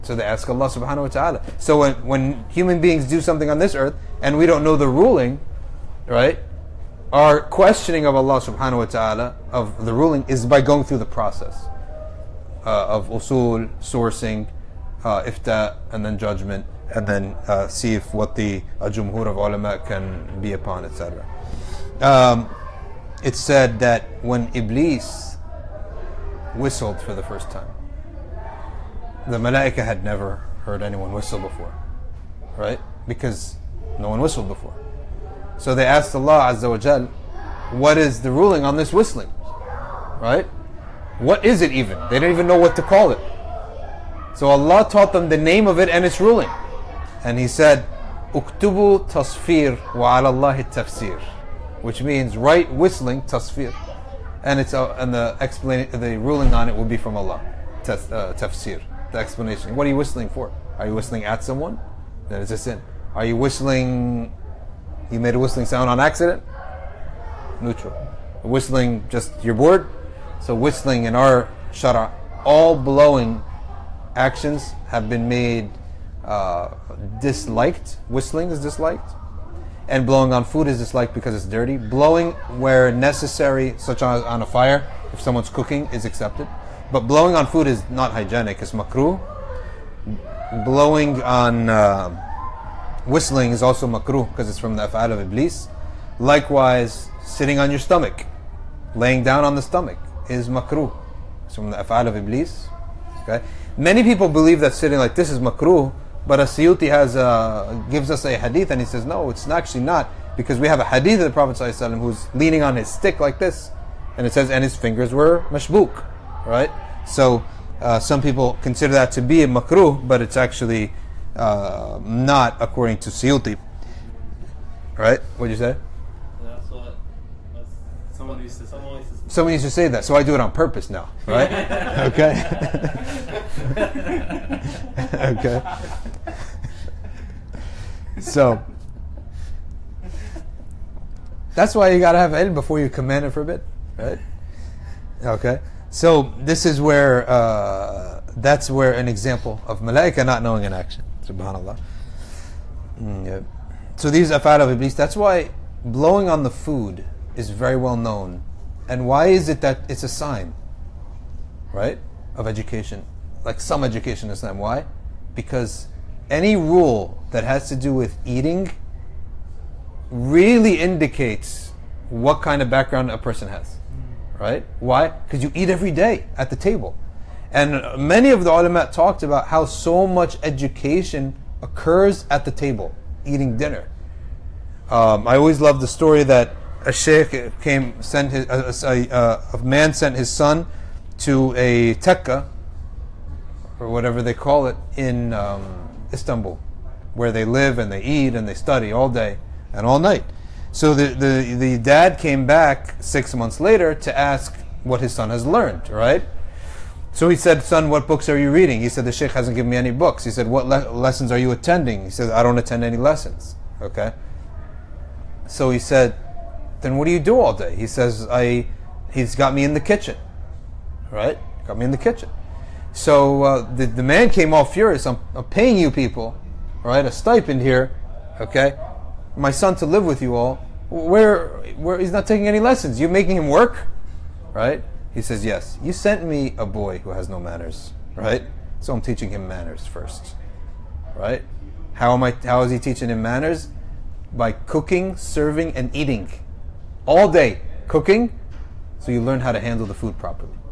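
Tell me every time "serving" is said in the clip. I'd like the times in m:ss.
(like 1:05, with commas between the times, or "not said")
4:05.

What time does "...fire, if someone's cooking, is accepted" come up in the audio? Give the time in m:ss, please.
1:24.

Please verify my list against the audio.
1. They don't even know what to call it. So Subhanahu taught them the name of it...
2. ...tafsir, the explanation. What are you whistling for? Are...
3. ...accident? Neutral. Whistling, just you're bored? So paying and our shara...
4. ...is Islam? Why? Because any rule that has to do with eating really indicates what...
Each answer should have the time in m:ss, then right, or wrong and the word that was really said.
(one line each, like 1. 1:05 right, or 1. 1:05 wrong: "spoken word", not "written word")
1. 0:42 wrong: "Allah", not "Subhanahu"
2. 0:58 right
3. 1:06 wrong: "whistling", not "paying"
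4. 2:44 right.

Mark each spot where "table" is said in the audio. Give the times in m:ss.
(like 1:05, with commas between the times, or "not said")
2:56, 3:02.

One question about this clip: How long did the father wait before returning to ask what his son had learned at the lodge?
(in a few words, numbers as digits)
6 months.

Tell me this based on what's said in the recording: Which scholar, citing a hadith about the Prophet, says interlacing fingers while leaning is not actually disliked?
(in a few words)
As-Suyuti.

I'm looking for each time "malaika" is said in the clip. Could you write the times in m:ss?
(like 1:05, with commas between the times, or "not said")
0:29, 2:29.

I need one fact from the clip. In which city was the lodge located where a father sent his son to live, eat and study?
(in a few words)
Istanbul.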